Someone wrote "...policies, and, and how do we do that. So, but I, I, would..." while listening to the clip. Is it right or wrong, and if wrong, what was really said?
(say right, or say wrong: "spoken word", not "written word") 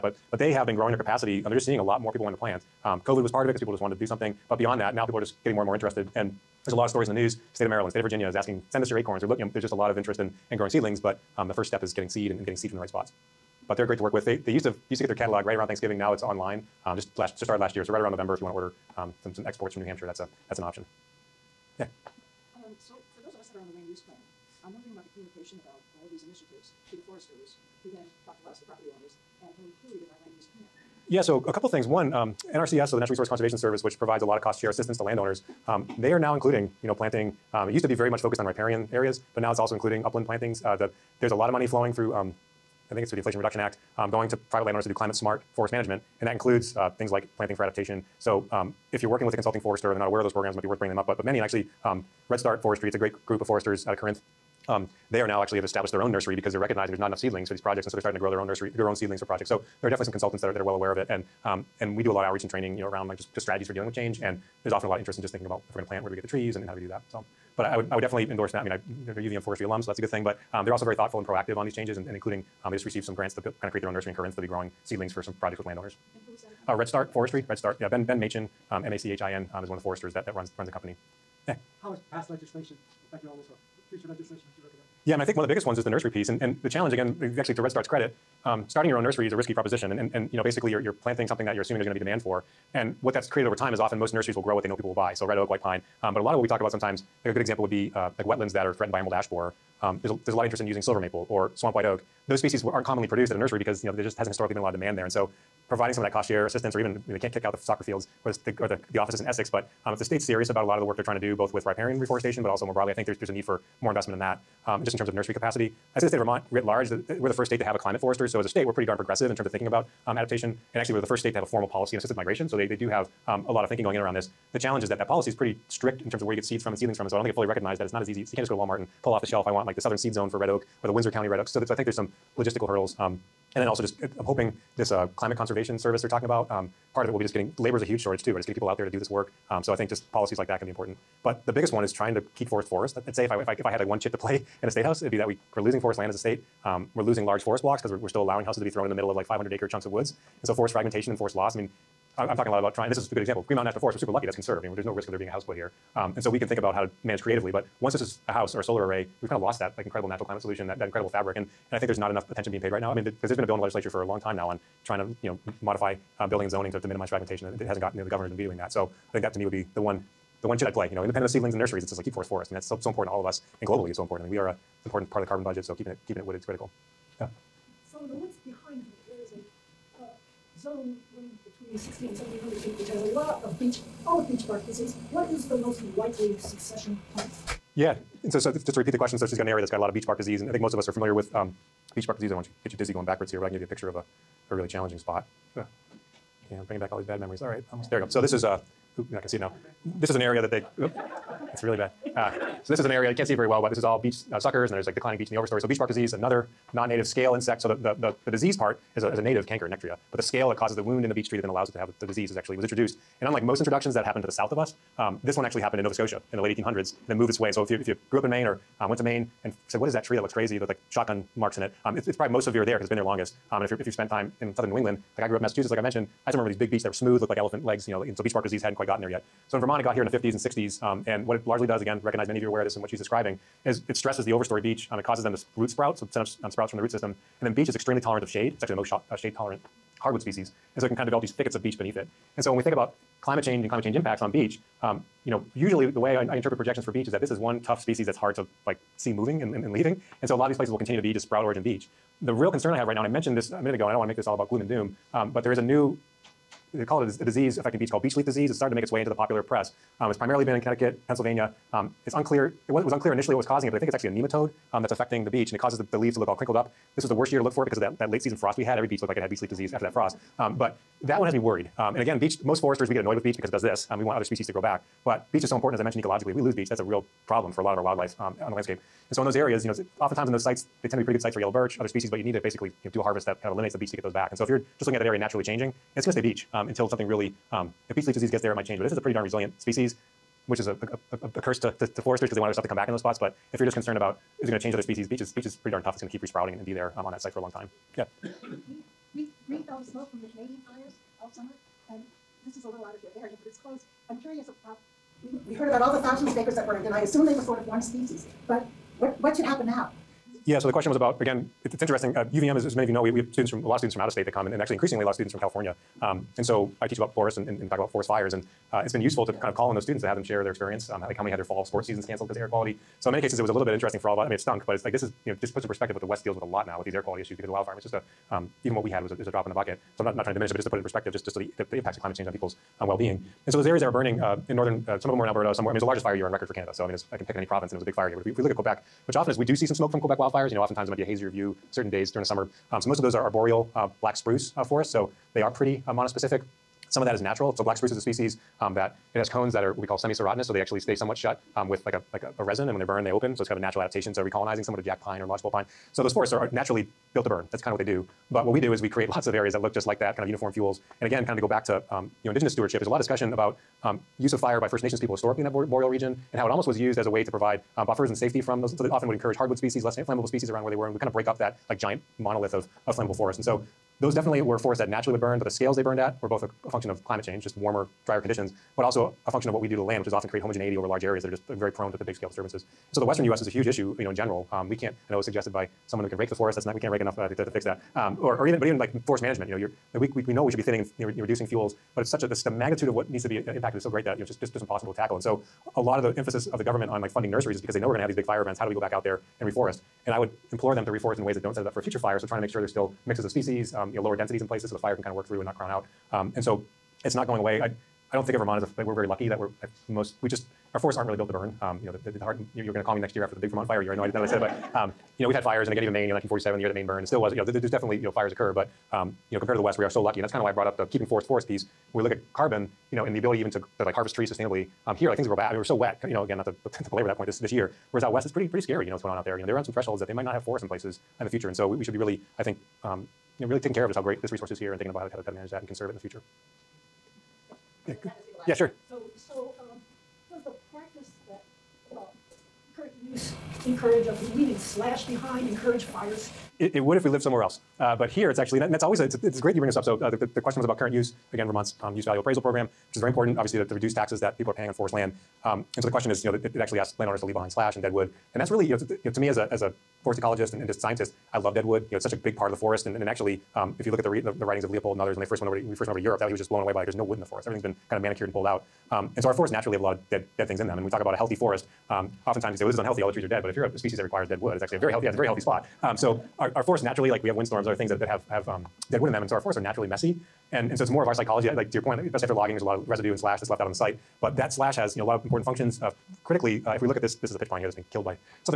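wrong: "trees", not "policies".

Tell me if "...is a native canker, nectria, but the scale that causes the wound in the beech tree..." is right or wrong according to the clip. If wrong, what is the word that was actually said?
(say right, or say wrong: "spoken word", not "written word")
right.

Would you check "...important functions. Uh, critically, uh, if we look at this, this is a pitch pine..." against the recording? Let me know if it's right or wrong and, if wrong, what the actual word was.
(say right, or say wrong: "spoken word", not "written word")
right.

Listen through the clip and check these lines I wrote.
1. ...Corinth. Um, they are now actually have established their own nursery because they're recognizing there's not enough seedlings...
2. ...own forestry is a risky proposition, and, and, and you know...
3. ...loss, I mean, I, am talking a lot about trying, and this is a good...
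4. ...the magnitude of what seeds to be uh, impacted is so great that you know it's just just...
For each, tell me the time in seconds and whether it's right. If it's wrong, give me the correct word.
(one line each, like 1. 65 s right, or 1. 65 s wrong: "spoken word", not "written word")
1. 53 s right
2. 88 s wrong: "nursery", not "forestry"
3. 151 s right
4. 392 s wrong: "needs", not "seeds".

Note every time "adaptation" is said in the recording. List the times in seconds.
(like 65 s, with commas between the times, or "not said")
47 s, 120 s, 353 s.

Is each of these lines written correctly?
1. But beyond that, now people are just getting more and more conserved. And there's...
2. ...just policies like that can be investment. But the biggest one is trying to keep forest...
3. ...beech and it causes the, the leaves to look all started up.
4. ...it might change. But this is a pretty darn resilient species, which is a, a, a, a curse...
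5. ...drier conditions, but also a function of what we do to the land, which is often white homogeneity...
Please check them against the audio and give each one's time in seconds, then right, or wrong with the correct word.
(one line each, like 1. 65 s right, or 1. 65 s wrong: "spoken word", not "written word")
1. 4 s wrong: "interested", not "conserved"
2. 139 s wrong: "important", not "investment"
3. 265 s wrong: "crinkled", not "started"
4. 288 s right
5. 378 s wrong: "create", not "white".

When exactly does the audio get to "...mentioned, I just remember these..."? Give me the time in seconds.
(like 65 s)
225 s.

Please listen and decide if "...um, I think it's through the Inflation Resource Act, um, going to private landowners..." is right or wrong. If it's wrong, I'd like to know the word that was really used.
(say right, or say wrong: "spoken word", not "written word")
wrong: "Reduction", not "Resource".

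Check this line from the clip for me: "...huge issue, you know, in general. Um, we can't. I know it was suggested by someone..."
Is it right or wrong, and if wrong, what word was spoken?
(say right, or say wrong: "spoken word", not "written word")
right.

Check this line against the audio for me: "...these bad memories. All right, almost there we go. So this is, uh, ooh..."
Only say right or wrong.
right.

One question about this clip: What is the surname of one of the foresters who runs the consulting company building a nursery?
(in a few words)
Machin.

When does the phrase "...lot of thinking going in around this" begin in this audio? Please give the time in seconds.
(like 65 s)
123 s.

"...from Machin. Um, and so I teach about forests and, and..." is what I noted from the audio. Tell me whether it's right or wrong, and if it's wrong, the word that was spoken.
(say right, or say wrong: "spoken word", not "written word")
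wrong: "California", not "Machin".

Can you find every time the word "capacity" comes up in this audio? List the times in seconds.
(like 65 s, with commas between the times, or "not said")
0 s, 115 s.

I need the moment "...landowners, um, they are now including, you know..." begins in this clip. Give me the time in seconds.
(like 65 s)
35 s.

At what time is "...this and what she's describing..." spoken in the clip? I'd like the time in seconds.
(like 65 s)
232 s.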